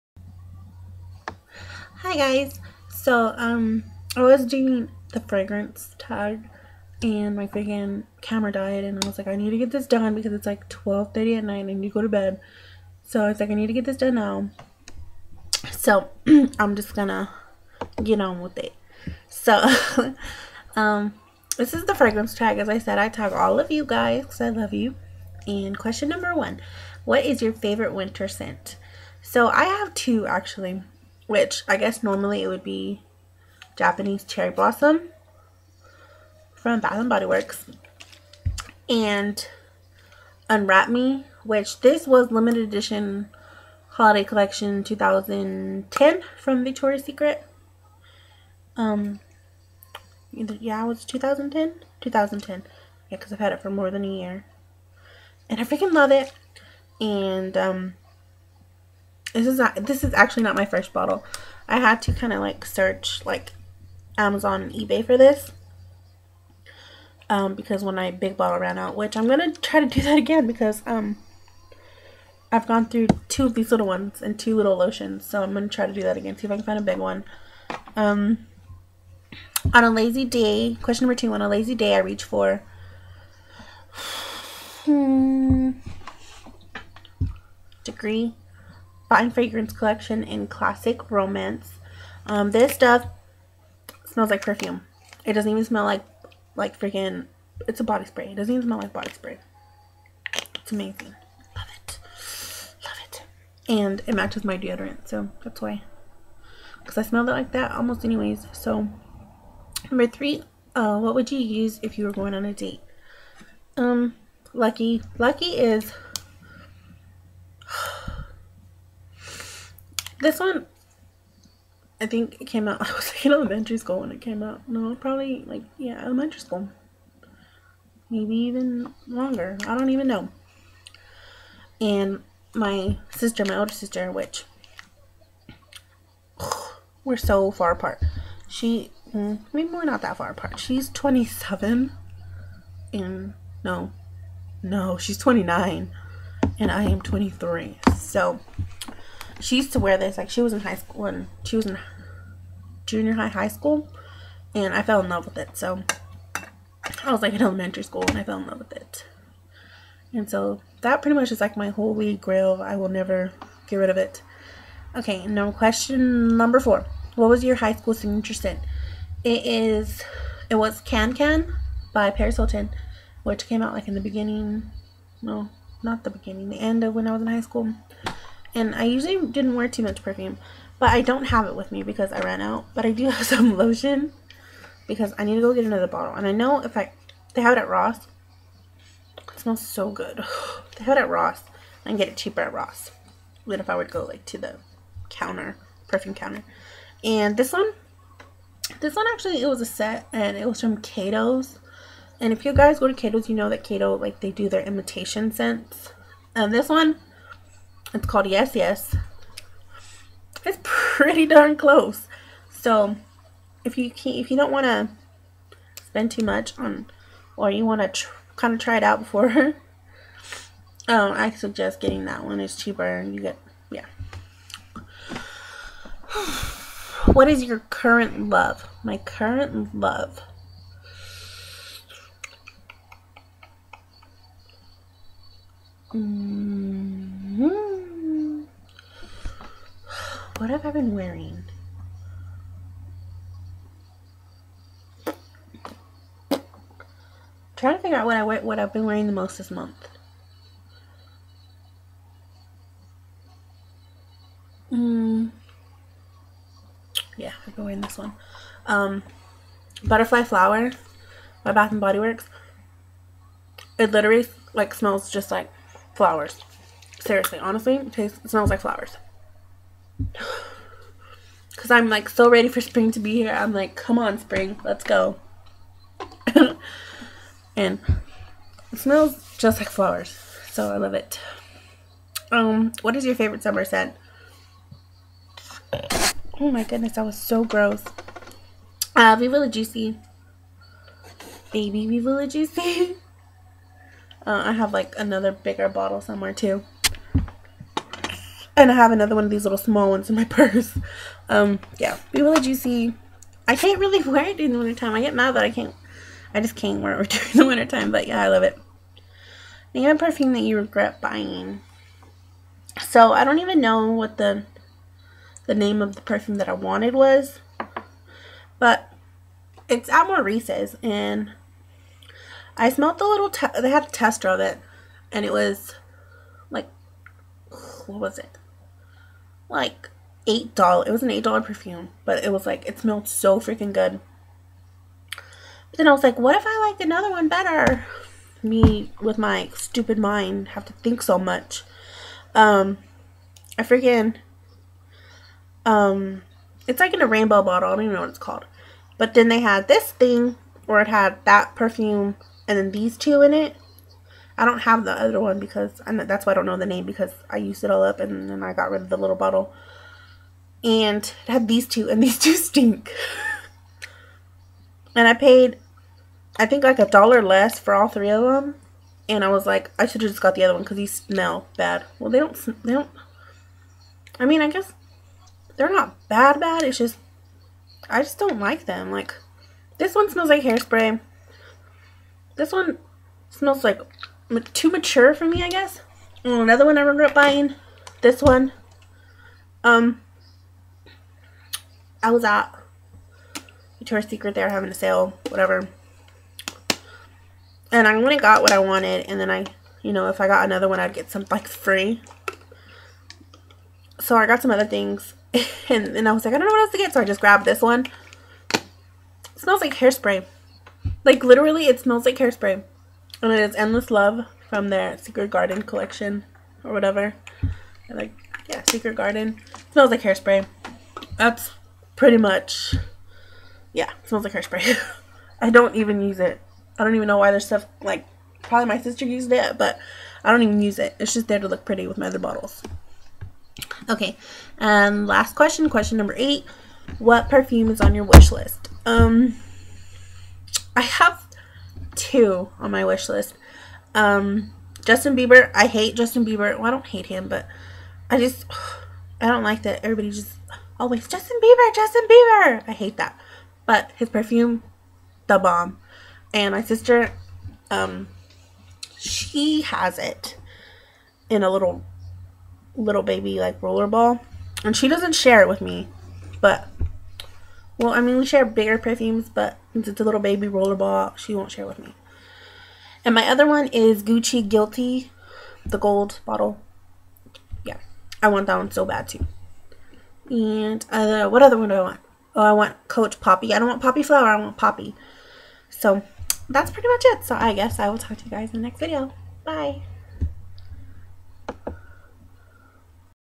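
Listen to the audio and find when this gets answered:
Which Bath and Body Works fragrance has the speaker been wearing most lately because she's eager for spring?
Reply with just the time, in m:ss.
4:19.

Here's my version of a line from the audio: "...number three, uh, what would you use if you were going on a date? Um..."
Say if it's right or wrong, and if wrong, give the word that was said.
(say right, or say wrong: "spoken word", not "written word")
right.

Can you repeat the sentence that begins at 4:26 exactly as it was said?
Seriously, honestly, it tastes it smells like flowers.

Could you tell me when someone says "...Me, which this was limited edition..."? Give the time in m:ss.
0:40.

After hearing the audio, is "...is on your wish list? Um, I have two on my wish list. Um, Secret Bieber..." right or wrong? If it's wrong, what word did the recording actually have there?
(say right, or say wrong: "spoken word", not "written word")
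wrong: "Justin", not "Secret".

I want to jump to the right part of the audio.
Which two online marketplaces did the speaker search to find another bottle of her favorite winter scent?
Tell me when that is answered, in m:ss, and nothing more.
1:04.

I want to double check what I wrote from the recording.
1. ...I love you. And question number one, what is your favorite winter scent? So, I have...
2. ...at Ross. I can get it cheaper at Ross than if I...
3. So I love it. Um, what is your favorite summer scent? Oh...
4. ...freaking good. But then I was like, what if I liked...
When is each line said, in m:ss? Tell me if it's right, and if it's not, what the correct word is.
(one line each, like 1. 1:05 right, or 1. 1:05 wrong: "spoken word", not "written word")
1. 0:24 right
2. 3:11 right
3. 4:40 right
4. 5:33 right.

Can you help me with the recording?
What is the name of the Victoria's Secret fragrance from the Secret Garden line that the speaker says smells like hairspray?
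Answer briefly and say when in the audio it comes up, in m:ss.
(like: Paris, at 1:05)
Endless Love, at 6:53.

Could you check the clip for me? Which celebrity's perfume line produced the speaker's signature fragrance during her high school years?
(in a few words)
Paris Hilton.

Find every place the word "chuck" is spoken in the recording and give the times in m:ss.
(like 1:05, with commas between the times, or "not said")
not said.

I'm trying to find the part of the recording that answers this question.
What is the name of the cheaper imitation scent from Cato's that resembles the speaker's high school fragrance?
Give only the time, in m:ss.
3:28.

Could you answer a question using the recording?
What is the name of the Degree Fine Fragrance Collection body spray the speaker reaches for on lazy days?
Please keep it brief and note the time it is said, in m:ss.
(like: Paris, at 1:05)
Classic Romance, at 1:30.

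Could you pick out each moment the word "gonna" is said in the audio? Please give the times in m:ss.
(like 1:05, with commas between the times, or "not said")
0:16, 1:09, 1:15.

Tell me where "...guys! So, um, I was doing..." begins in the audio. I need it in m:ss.
0:02.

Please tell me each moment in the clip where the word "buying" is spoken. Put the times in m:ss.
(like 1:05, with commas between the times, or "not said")
5:11, 6:27.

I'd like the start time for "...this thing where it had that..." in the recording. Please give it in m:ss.
5:49.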